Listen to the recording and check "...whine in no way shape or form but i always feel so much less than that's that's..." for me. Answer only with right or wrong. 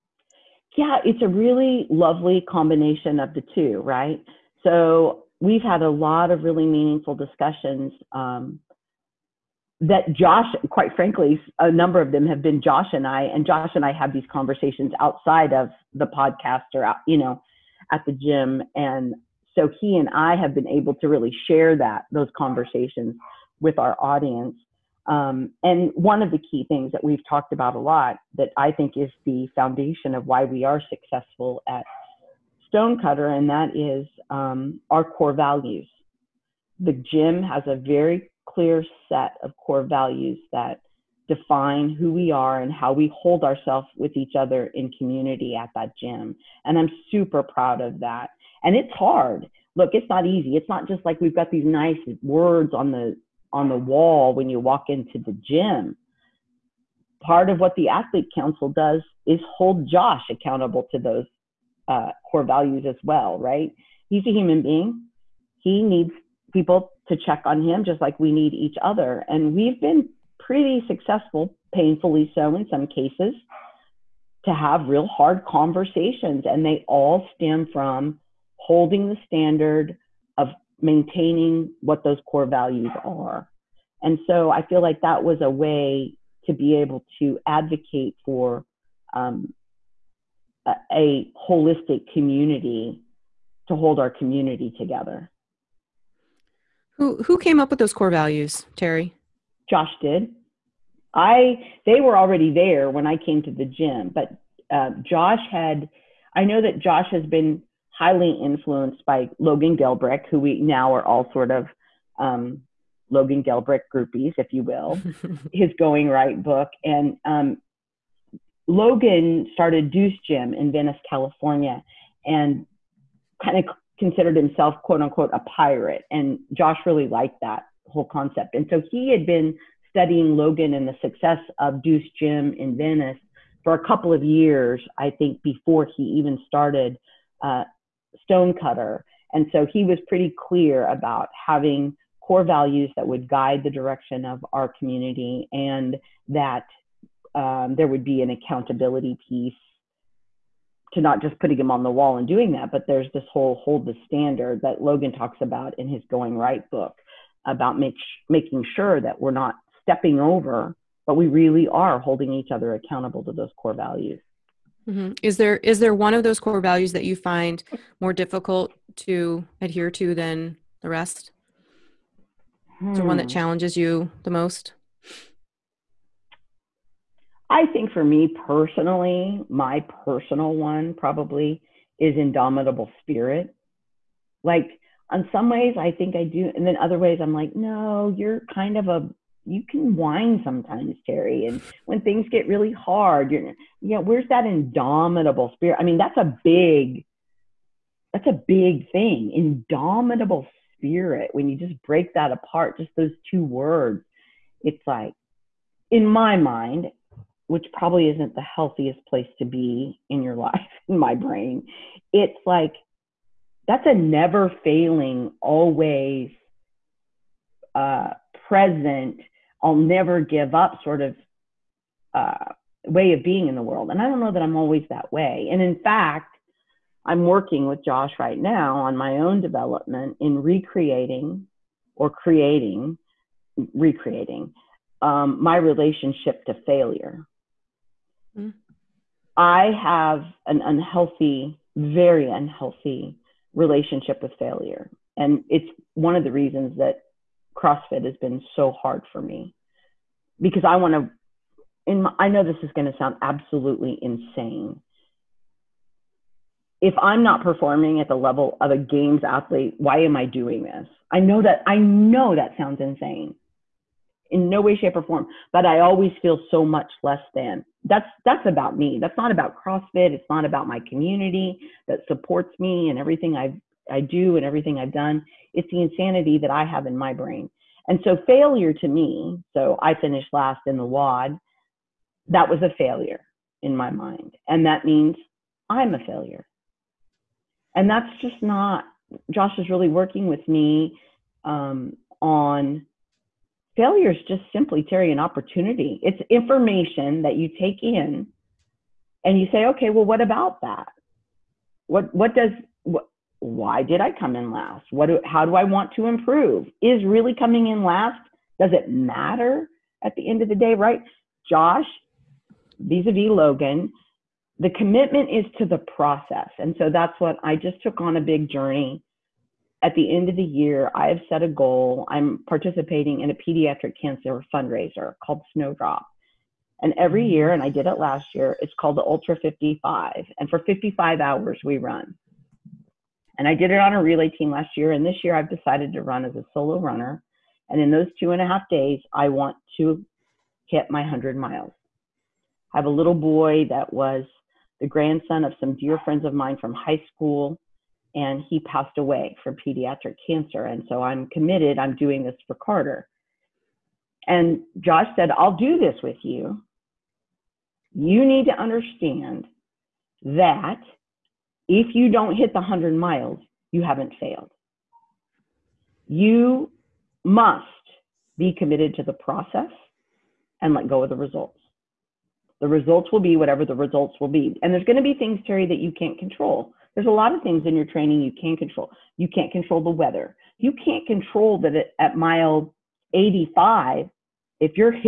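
wrong.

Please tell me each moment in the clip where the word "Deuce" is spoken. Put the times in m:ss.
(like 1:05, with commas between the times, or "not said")
1:59, 2:11.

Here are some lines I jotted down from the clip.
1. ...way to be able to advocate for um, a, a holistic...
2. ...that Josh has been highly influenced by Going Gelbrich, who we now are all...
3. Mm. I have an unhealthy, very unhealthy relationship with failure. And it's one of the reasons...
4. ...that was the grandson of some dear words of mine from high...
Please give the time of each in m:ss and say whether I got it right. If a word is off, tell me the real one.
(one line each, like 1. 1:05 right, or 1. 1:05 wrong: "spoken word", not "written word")
1. 1:25 right
2. 1:46 wrong: "Logan", not "Going"
3. 3:58 right
4. 5:43 wrong: "friends", not "words".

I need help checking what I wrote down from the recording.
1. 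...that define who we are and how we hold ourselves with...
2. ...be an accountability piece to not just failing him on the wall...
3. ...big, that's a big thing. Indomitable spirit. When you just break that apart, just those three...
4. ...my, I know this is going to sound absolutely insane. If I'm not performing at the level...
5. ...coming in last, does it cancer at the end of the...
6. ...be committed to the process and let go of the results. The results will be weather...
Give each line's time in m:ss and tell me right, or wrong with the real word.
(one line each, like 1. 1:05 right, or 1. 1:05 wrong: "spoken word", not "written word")
1. 0:40 right
2. 2:28 wrong: "putting", not "failing"
3. 3:16 wrong: "two", not "three"
4. 4:12 right
5. 5:07 wrong: "matter", not "cancer"
6. 6:08 wrong: "whatever", not "weather".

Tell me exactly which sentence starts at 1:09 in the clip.
And we've been pretty successful, painfully so in some cases, to have real hard conversations.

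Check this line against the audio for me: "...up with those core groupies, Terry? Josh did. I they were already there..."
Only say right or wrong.
wrong.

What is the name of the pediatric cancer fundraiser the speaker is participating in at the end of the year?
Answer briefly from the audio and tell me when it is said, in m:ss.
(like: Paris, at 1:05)
Snowdrop, at 5:25.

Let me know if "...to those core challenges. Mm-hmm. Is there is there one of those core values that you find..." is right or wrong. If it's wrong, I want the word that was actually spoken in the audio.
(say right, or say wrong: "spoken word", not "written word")
wrong: "values", not "challenges".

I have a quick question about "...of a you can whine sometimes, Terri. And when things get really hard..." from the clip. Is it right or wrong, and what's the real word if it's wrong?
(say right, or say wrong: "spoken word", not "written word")
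right.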